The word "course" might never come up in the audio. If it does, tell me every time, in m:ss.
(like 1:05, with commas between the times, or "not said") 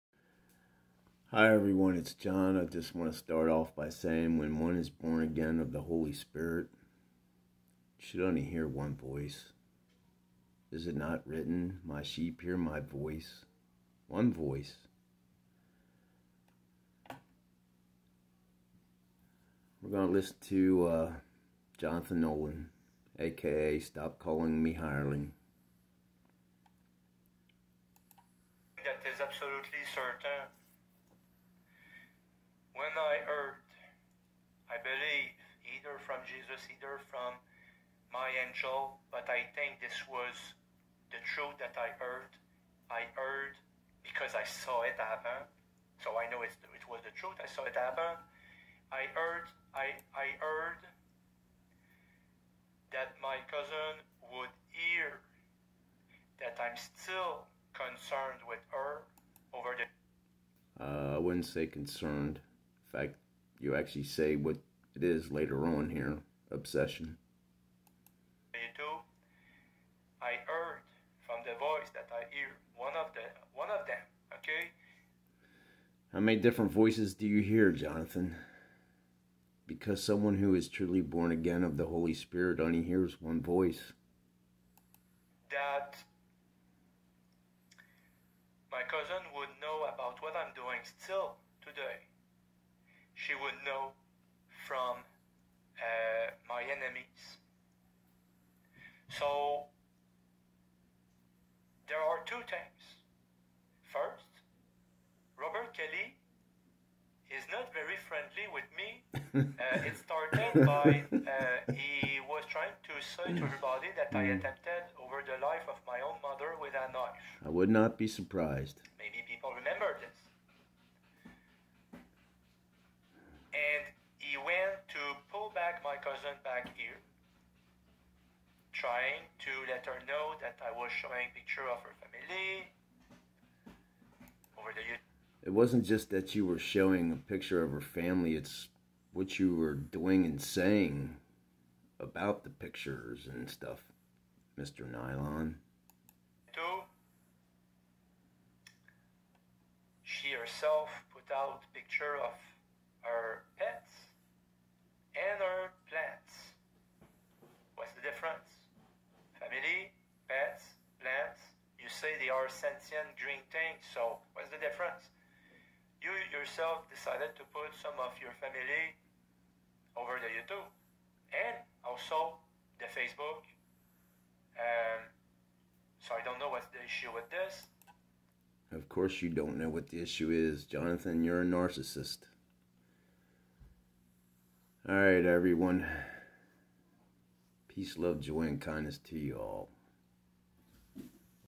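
2:58.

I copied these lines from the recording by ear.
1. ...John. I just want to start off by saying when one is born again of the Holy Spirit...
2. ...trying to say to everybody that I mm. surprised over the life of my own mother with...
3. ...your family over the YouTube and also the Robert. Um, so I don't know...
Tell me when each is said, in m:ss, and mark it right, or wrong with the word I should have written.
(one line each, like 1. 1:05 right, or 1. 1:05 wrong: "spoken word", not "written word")
1. 0:02 right
2. 1:52 wrong: "attempted", not "surprised"
3. 2:48 wrong: "Facebook", not "Robert".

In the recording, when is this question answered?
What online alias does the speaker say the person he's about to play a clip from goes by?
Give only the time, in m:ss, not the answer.
0:23.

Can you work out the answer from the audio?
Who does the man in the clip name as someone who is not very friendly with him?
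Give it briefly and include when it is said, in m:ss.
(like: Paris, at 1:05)
Robert Kelly, at 1:45.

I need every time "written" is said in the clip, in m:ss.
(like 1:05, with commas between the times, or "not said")
0:11.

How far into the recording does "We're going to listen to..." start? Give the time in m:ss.
0:19.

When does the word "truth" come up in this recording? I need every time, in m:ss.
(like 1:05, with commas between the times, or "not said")
0:41, 0:47.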